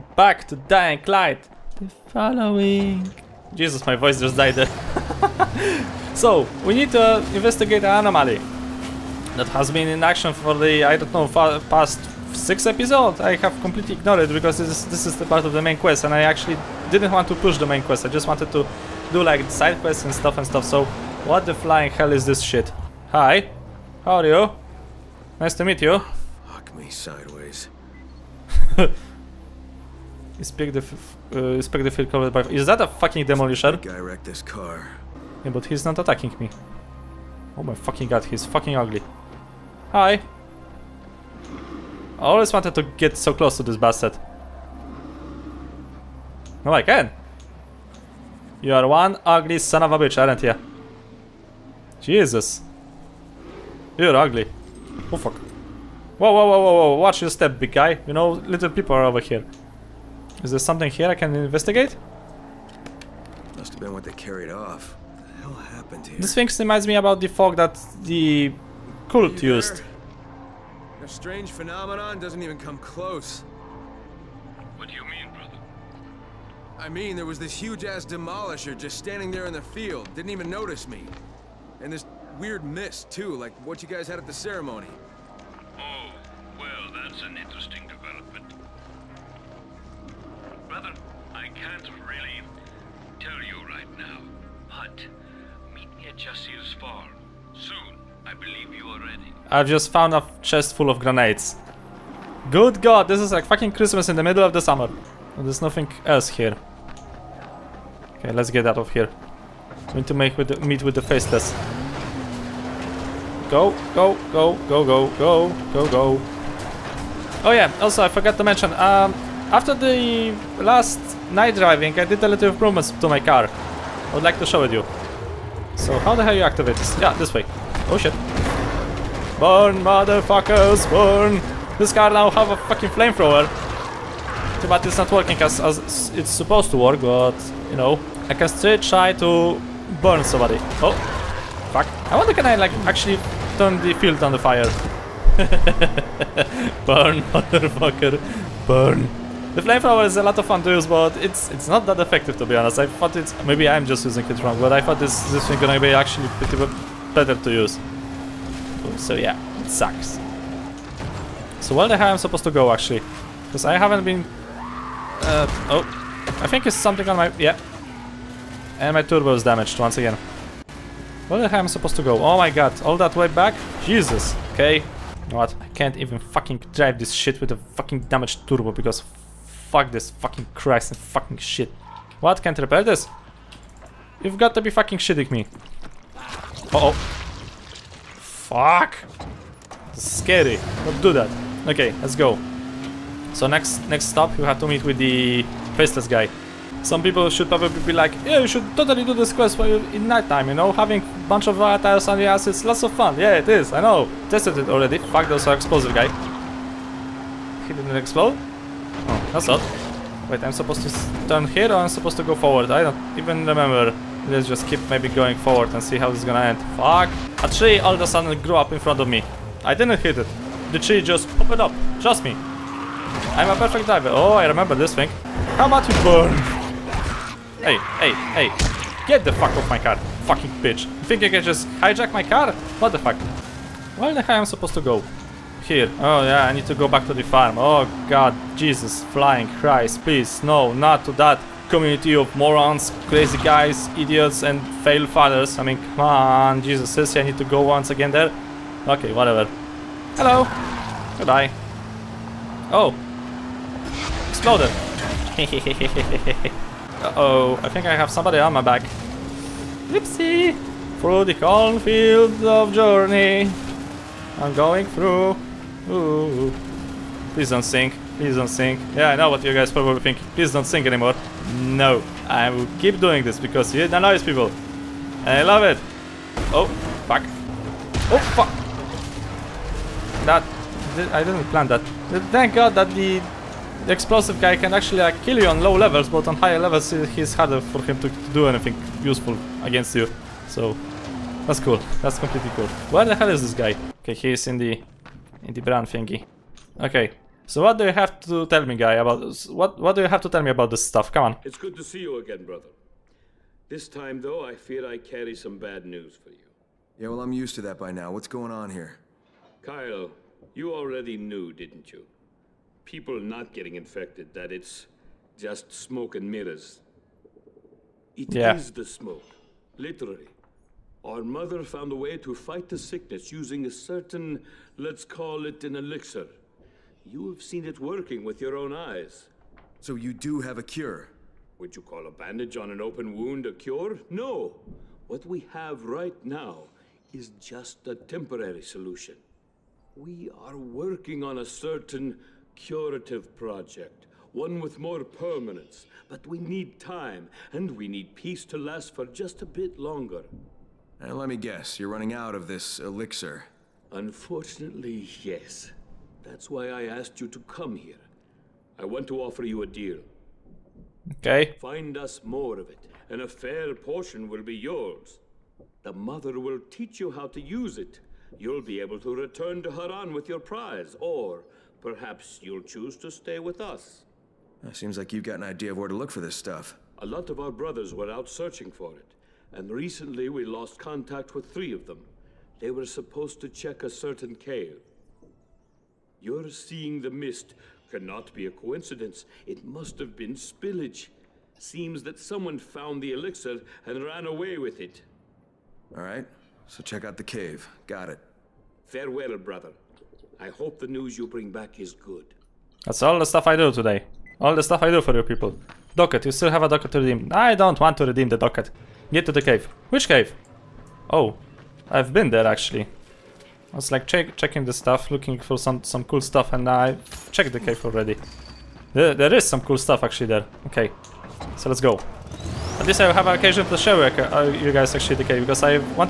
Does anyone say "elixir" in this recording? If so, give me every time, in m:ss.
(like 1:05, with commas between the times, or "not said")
5:25, 5:52, 6:33.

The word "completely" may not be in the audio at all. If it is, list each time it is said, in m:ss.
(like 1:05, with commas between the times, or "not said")
0:13, 4:52.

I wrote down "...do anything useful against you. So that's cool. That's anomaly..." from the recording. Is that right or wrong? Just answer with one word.
wrong.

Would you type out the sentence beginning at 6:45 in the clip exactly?
Docket, you still have a docket to redeem.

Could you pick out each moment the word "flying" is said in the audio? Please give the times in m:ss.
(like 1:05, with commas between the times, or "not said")
0:21, 3:59.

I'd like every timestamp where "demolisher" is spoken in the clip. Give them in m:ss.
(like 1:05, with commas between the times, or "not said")
0:33, 1:18.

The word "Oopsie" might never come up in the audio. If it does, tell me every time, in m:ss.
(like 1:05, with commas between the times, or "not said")
4:19.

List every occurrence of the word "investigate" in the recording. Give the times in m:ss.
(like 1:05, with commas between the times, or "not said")
0:07, 1:01.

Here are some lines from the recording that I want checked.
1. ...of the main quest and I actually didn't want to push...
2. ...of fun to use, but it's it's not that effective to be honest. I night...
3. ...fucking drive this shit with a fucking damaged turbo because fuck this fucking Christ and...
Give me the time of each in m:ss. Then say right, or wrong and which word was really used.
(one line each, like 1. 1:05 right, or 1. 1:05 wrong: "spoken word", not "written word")
1. 0:15 right
2. 2:30 wrong: "thought", not "night"
3. 2:56 right.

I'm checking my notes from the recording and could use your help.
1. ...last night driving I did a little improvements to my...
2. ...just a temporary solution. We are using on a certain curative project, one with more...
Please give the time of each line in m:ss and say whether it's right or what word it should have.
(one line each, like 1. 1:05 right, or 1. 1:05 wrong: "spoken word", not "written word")
1. 2:00 right
2. 5:37 wrong: "working", not "using".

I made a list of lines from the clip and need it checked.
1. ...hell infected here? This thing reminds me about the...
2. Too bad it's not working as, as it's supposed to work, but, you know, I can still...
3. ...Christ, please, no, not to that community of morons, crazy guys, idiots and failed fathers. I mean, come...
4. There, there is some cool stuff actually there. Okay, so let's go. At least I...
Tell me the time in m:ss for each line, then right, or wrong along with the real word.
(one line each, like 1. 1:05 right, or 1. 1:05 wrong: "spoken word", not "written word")
1. 1:05 wrong: "happened", not "infected"
2. 2:14 right
3. 3:59 right
4. 6:58 right.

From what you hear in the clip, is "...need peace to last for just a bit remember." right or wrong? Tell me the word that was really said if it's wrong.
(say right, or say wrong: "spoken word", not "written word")
wrong: "longer", not "remember".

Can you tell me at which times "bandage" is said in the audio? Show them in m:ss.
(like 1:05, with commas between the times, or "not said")
5:32.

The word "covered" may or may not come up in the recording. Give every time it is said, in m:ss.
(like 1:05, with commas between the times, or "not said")
0:32.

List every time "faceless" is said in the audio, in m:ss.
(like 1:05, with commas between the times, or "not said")
1:51, 3:15.